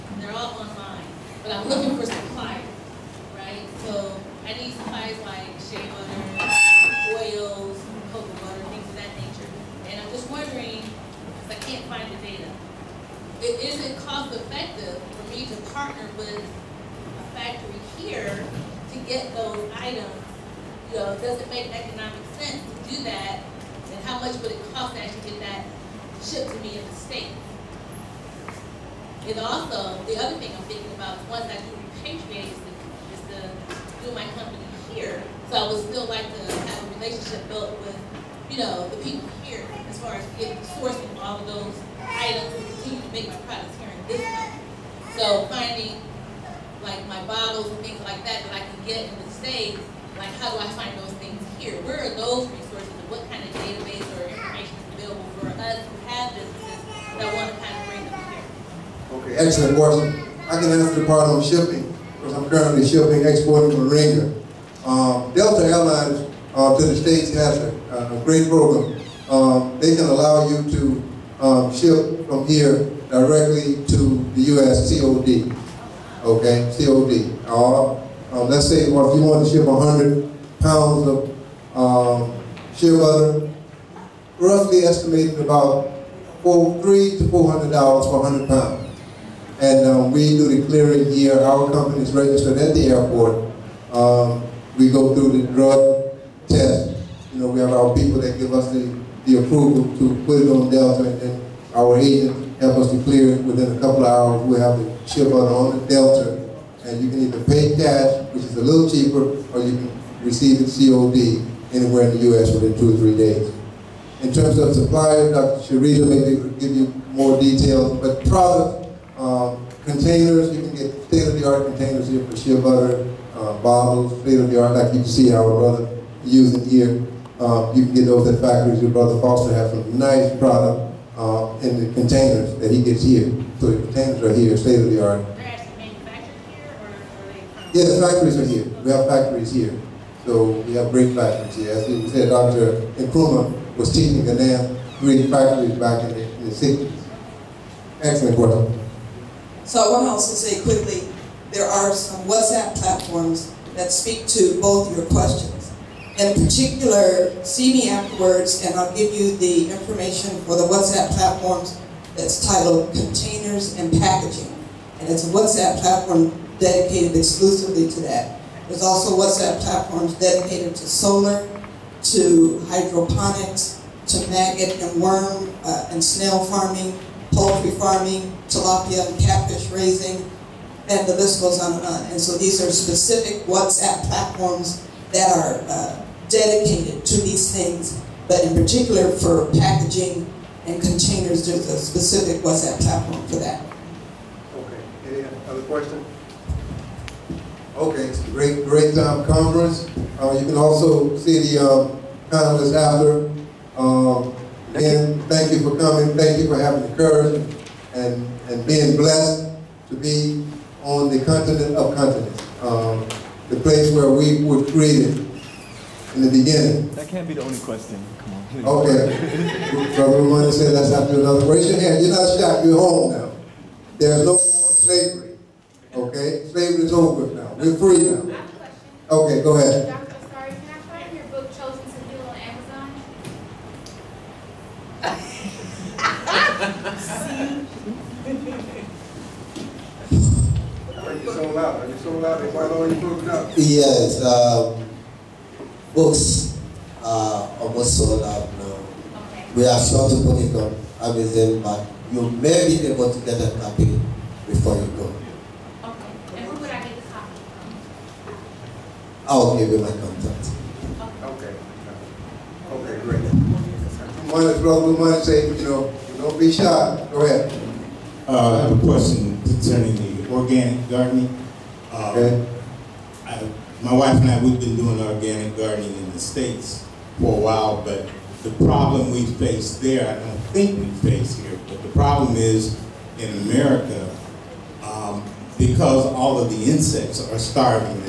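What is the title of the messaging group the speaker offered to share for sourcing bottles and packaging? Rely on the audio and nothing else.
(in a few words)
Containers and Packaging.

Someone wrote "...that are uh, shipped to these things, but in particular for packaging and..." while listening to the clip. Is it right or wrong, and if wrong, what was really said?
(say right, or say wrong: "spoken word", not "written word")
wrong: "dedicated", not "shipped".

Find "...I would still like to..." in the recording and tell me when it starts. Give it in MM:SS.
00:35.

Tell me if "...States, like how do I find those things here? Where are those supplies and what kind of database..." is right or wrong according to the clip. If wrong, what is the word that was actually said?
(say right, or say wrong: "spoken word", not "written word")
wrong: "resources", not "supplies".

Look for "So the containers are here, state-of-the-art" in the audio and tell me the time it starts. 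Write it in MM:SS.
02:13.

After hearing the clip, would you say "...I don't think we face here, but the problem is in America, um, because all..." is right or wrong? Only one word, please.
right.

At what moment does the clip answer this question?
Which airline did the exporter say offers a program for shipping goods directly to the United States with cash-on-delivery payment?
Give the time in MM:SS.
01:05.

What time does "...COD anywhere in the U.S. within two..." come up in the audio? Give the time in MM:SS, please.
01:50.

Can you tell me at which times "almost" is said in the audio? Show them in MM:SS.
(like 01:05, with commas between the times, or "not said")
04:07.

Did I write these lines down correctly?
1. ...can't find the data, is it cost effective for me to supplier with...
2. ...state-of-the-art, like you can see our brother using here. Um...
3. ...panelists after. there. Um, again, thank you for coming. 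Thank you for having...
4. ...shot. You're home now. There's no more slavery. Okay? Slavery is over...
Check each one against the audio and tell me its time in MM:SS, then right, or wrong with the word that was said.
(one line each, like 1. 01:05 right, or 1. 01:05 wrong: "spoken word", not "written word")
1. 00:11 wrong: "partner", not "supplier"
2. 02:04 right
3. 03:22 right
4. 03:42 right.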